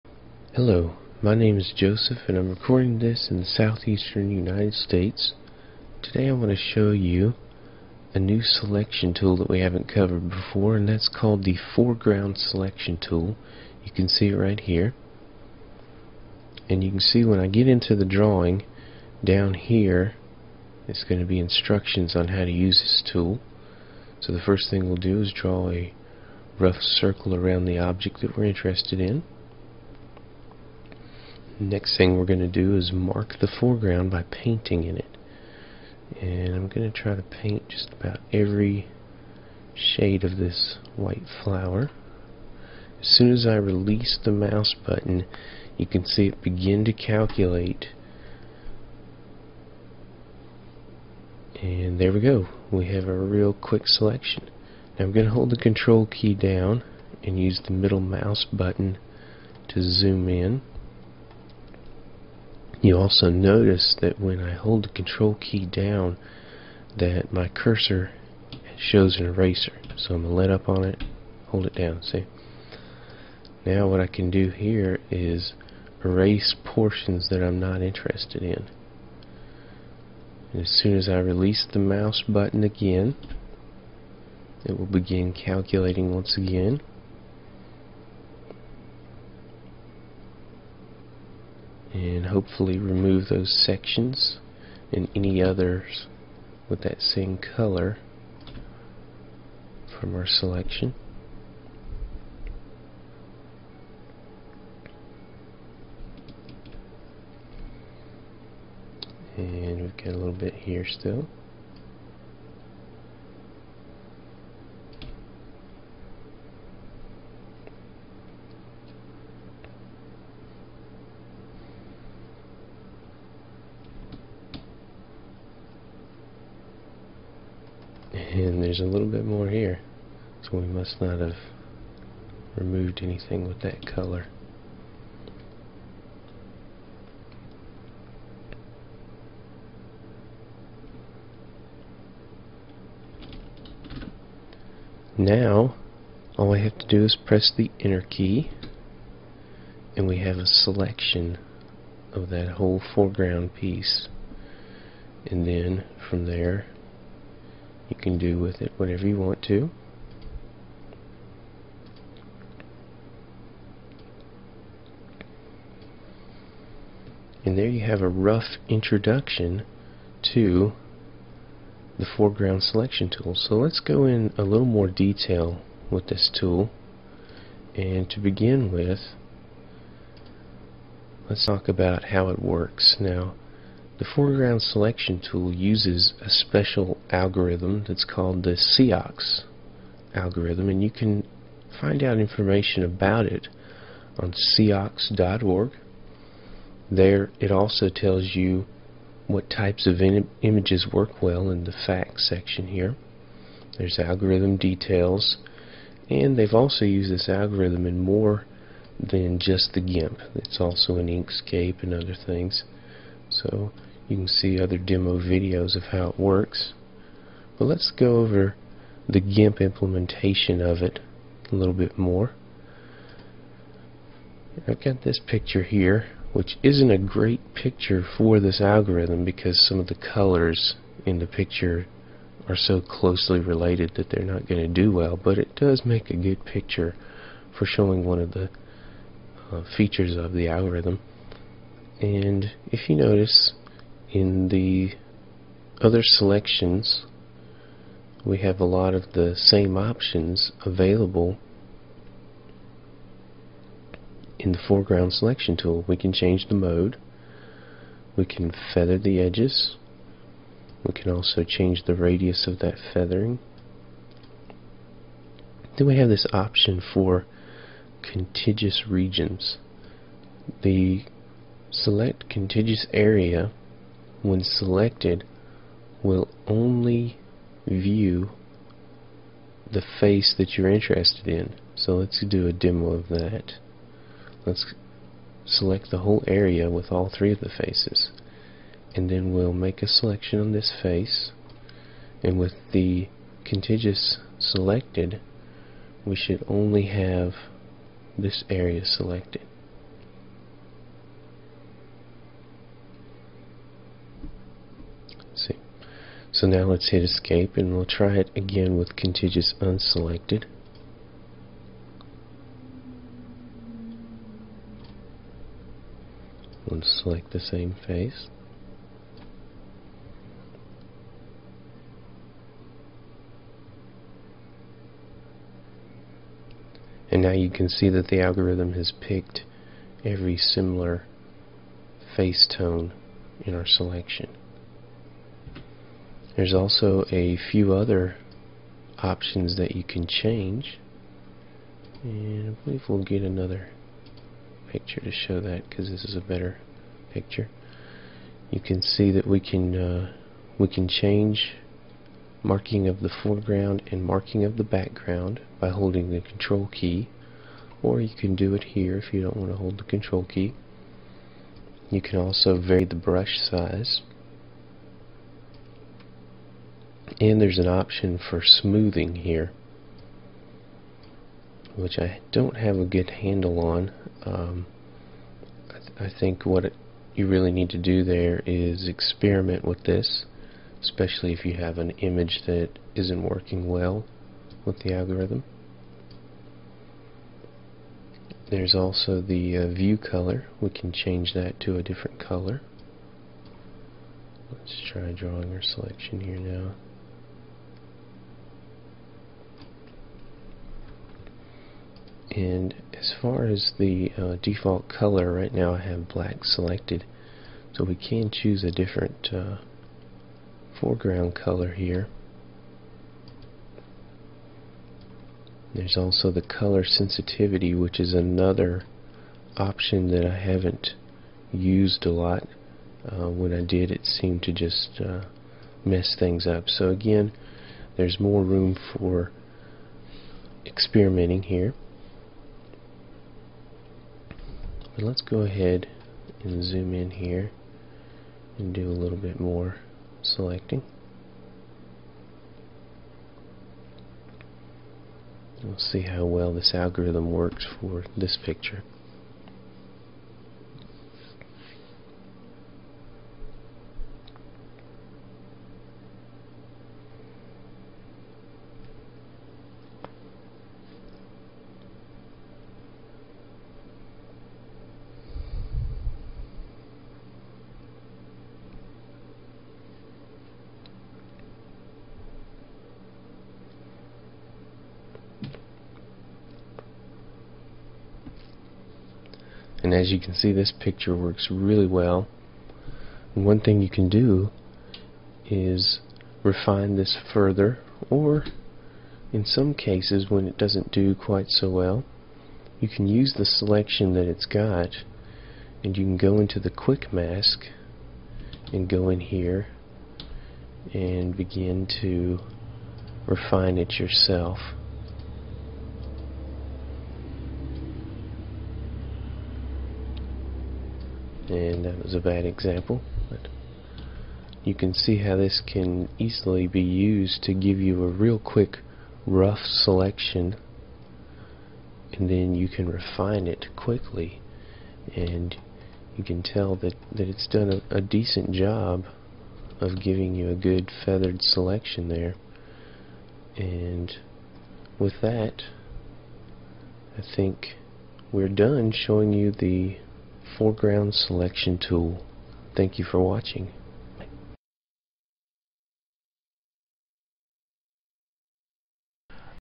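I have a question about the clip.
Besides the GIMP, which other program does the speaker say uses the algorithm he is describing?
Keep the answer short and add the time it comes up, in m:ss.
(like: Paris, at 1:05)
Inkscape, at 3:31.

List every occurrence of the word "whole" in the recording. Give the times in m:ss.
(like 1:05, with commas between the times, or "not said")
2:32, 4:45.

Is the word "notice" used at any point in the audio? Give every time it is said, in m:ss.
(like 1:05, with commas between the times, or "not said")
1:03, 4:02.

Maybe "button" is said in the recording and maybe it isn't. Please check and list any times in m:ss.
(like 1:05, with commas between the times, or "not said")
0:44, 0:58, 1:22.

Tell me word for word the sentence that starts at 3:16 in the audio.
There it also tells you what types of Im images work well in the facts section here.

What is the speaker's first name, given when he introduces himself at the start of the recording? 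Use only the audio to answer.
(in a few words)
Joseph.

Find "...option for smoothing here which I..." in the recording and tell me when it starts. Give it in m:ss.
6:07.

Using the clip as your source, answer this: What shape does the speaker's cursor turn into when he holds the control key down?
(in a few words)
eraser.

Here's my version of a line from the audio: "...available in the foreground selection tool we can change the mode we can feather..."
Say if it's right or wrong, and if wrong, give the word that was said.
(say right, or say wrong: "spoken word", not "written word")
right.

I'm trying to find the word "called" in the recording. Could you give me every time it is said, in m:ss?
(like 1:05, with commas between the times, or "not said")
0:11, 3:08.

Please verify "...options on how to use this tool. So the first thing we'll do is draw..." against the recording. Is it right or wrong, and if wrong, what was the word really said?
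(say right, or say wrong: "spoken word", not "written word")
wrong: "instructions", not "options".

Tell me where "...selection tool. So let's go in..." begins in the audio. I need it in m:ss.
2:52.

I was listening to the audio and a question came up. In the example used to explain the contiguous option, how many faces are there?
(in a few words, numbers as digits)
3.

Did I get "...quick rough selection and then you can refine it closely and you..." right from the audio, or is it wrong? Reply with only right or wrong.
wrong.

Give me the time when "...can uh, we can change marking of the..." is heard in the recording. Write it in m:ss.
5:49.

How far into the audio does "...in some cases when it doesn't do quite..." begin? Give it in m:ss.
8:09.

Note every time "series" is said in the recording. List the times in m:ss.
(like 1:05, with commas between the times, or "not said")
not said.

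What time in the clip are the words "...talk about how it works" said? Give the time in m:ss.
3:01.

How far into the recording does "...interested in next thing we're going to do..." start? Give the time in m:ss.
0:28.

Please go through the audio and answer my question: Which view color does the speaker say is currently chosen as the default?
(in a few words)
black.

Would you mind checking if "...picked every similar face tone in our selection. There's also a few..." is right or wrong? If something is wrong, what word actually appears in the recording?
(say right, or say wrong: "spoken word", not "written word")
right.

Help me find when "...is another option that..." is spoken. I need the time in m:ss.
6:57.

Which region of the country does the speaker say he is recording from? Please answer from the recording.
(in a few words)
southeastern United States.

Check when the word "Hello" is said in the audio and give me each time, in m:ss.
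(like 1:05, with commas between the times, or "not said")
0:00.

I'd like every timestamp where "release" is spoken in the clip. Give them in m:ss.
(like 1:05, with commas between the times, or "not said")
0:43, 1:21.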